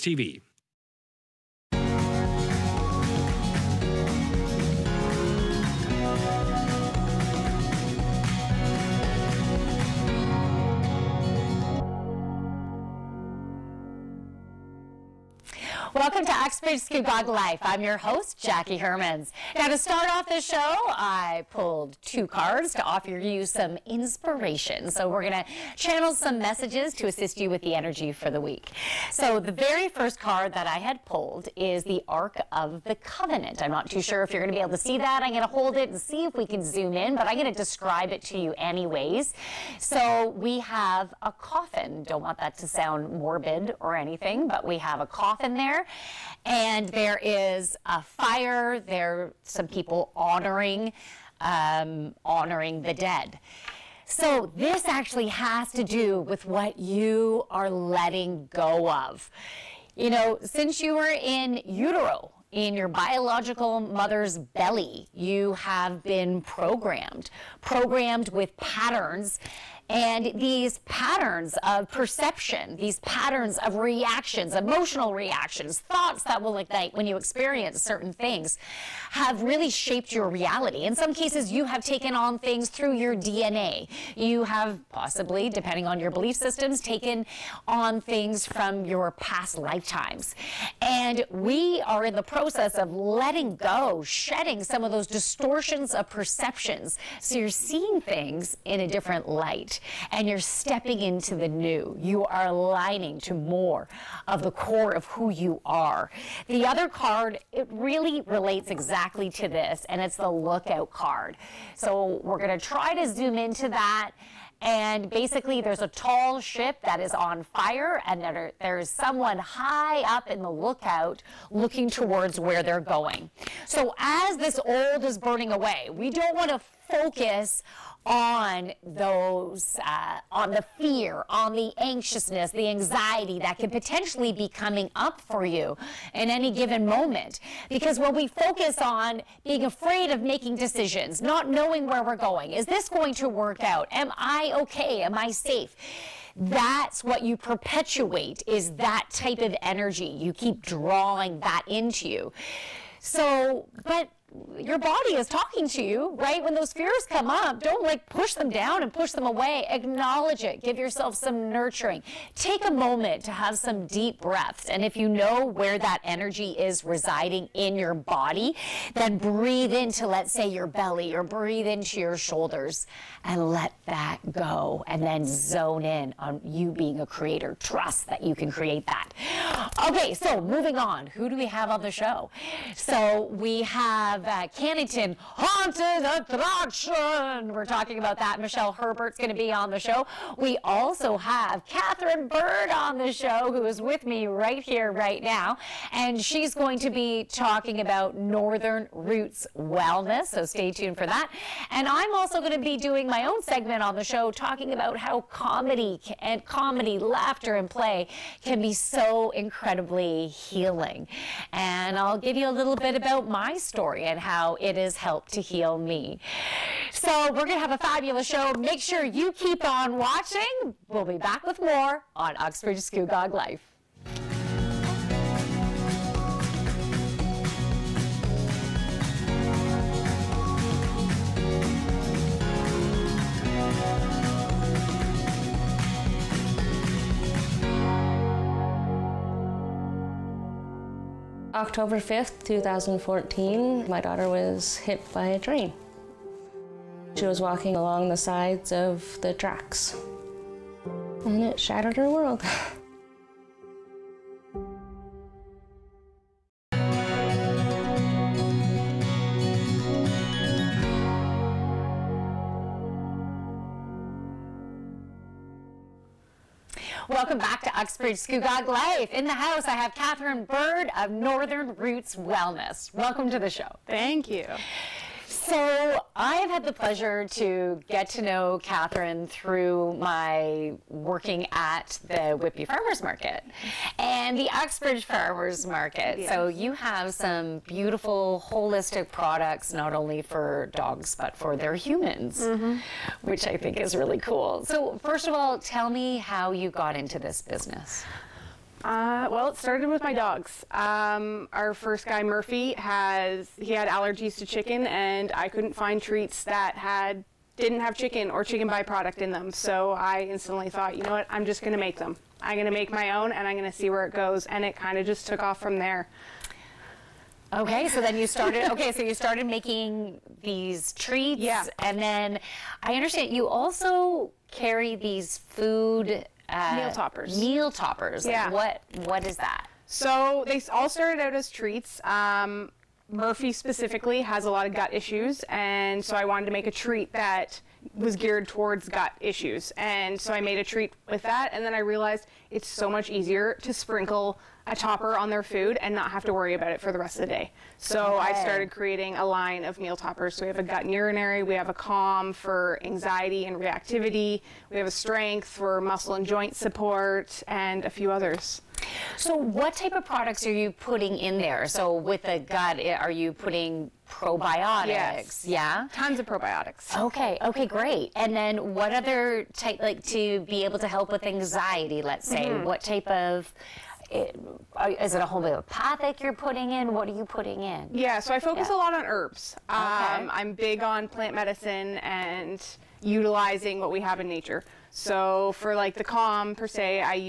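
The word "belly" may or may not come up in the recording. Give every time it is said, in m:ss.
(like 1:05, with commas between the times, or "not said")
1:04, 2:50.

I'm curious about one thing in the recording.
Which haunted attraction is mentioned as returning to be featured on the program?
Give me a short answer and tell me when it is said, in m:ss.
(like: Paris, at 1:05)
Cannington Haunted Attraction, at 3:04.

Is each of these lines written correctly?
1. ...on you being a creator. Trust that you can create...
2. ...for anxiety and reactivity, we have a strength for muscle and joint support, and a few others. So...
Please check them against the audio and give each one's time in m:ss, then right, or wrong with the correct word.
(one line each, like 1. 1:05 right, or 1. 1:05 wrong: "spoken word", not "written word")
1. 2:56 right
2. 5:52 right.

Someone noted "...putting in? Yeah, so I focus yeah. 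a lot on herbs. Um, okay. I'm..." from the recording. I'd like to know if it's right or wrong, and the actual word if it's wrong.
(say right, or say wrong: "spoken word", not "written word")
right.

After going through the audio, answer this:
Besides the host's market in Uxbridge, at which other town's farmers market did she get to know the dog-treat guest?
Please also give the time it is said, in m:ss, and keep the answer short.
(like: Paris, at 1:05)
Whitby, at 4:42.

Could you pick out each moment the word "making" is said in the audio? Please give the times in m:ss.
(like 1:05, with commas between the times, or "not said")
2:20, 5:19.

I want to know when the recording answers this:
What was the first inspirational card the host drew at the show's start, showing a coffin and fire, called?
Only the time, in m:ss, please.
0:32.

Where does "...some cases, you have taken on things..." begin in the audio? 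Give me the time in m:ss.
1:20.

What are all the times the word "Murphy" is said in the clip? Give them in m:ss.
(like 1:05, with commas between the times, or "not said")
5:02, 5:33.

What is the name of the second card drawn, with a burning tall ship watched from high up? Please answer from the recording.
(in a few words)
Lookout card.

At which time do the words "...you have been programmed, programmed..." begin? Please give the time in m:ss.
1:05.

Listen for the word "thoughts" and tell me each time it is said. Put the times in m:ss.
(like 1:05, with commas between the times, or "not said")
1:15, 5:10.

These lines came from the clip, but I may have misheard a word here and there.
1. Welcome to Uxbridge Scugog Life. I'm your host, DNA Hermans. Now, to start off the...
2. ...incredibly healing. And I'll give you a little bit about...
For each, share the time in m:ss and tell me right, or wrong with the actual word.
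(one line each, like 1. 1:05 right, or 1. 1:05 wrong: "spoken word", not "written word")
1. 0:15 wrong: "Jackie", not "DNA"
2. 3:29 right.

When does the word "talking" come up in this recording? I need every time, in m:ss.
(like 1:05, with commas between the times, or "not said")
2:35, 3:07, 3:17, 3:24.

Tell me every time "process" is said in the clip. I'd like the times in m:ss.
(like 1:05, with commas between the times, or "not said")
1:32.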